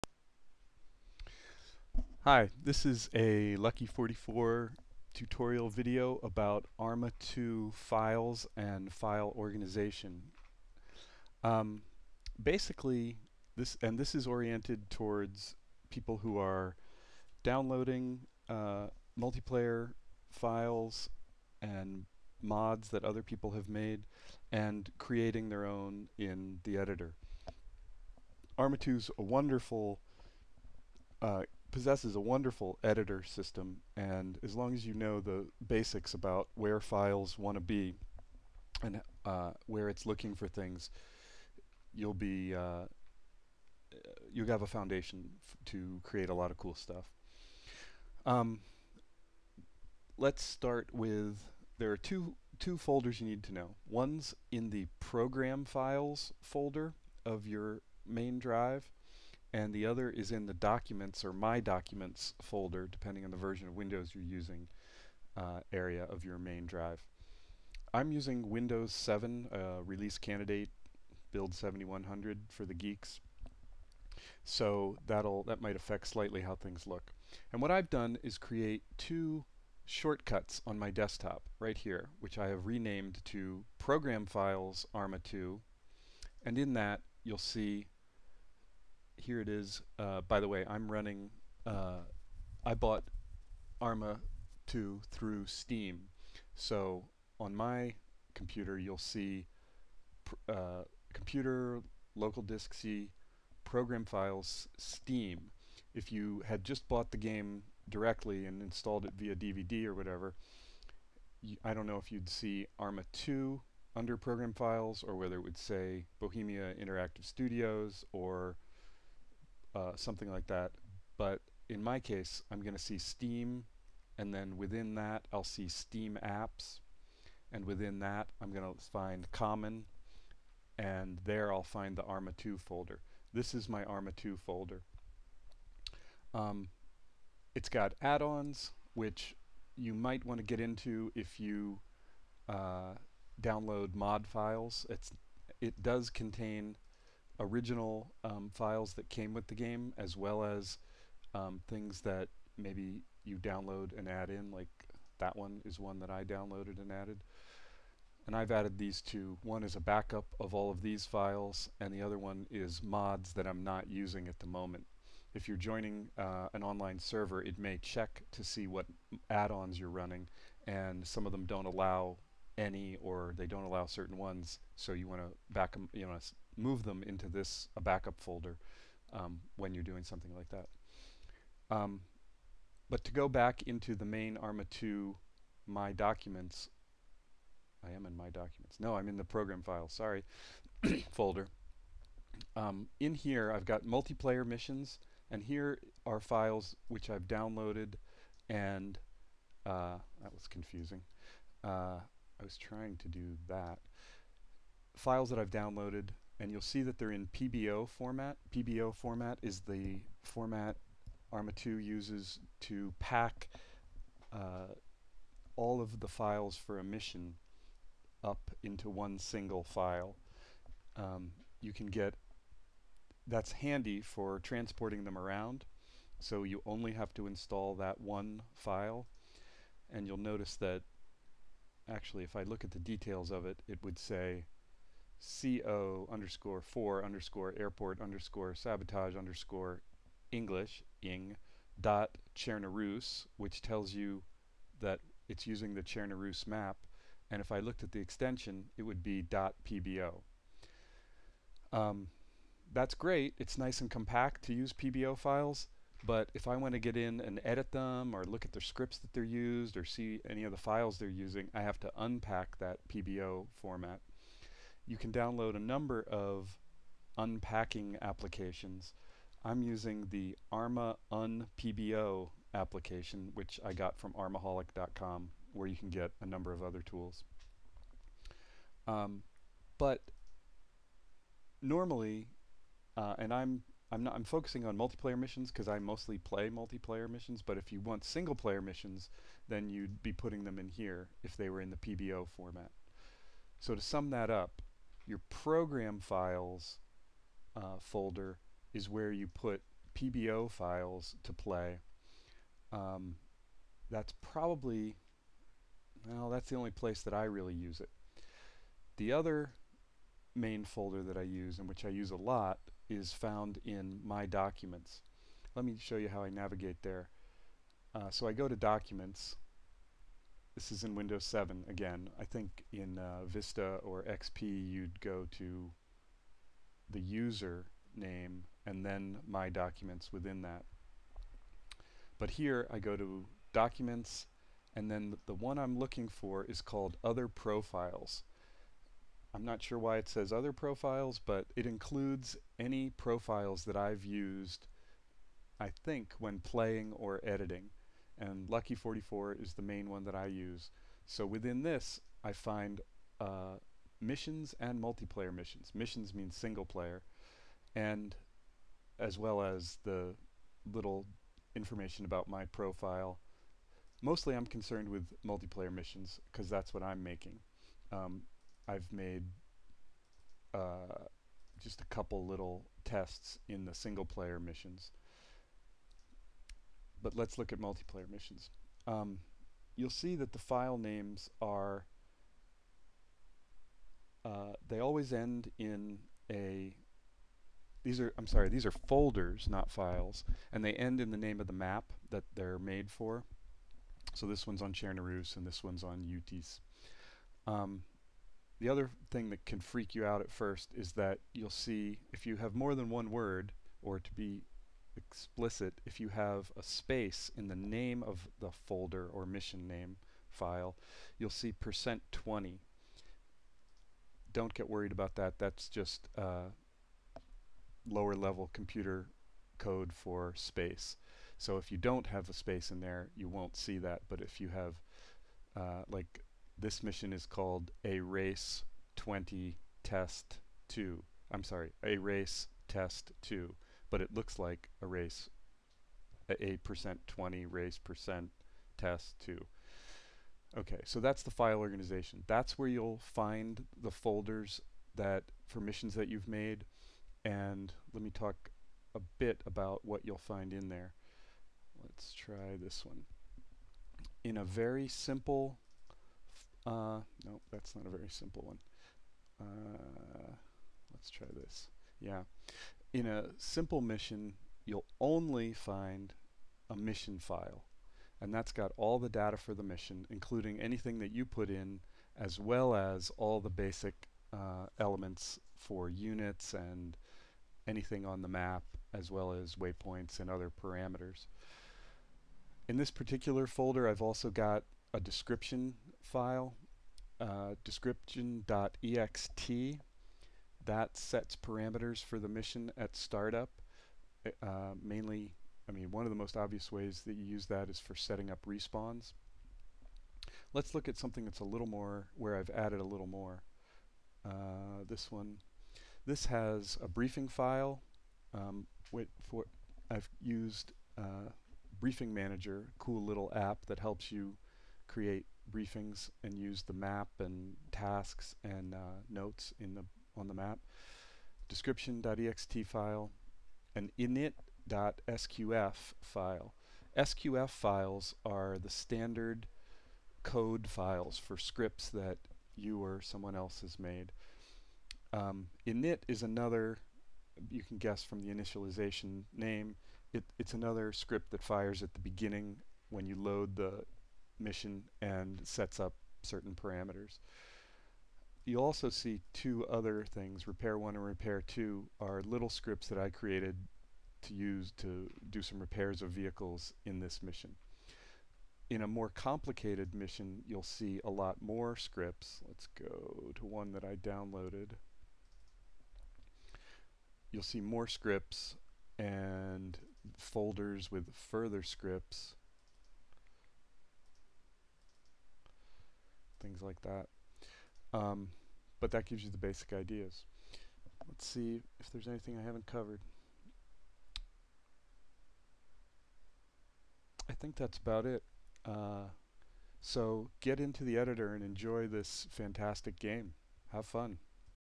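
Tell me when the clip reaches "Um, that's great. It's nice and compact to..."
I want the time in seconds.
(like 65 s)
251 s.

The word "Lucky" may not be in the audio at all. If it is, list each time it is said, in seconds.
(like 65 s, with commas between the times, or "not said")
3 s, 348 s.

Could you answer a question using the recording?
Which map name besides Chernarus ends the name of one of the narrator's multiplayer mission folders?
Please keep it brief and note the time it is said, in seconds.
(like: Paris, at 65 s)
Utes, at 396 s.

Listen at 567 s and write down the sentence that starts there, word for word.
You'll see more scripts and folders with further scripts, things like that.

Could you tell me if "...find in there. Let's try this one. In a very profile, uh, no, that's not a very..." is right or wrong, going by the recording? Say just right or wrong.
wrong.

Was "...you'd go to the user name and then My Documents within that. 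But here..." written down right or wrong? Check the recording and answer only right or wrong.
right.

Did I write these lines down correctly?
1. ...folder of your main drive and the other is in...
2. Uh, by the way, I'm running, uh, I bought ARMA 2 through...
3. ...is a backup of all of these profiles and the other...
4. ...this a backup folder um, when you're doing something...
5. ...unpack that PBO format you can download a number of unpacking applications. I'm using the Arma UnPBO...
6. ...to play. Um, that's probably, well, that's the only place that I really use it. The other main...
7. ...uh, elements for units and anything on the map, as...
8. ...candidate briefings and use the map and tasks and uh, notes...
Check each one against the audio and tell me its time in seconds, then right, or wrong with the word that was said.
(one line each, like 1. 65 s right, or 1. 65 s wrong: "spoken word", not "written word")
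1. 56 s right
2. 89 s right
3. 159 s wrong: "files", not "profiles"
4. 177 s right
5. 261 s right
6. 301 s right
7. 474 s right
8. 514 s wrong: "create", not "candidate".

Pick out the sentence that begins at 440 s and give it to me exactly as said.
Okay, so that's the file organization.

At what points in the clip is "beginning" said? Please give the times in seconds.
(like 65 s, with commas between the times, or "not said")
541 s.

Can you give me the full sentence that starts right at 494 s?
Uh, mainly, I mean, one of the most obvious ways that you use that is for setting up respawns.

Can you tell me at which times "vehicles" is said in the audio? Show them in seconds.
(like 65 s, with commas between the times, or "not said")
556 s.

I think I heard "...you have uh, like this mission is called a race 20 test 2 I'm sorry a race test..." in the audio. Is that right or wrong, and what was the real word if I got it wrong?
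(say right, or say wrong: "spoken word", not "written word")
right.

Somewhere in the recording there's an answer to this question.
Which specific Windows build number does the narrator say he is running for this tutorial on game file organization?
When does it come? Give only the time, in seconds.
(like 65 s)
71 s.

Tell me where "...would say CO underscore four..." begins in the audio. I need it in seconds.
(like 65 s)
233 s.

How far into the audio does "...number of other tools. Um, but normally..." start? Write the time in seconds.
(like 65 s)
276 s.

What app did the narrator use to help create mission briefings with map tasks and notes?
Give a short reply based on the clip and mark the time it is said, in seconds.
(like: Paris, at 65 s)
Briefing Manager, at 511 s.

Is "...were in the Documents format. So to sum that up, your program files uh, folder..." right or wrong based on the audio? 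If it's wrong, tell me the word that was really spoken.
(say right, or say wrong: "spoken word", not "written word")
wrong: "PBO", not "Documents".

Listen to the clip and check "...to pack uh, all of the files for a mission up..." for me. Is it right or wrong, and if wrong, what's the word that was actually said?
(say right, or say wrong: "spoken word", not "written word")
right.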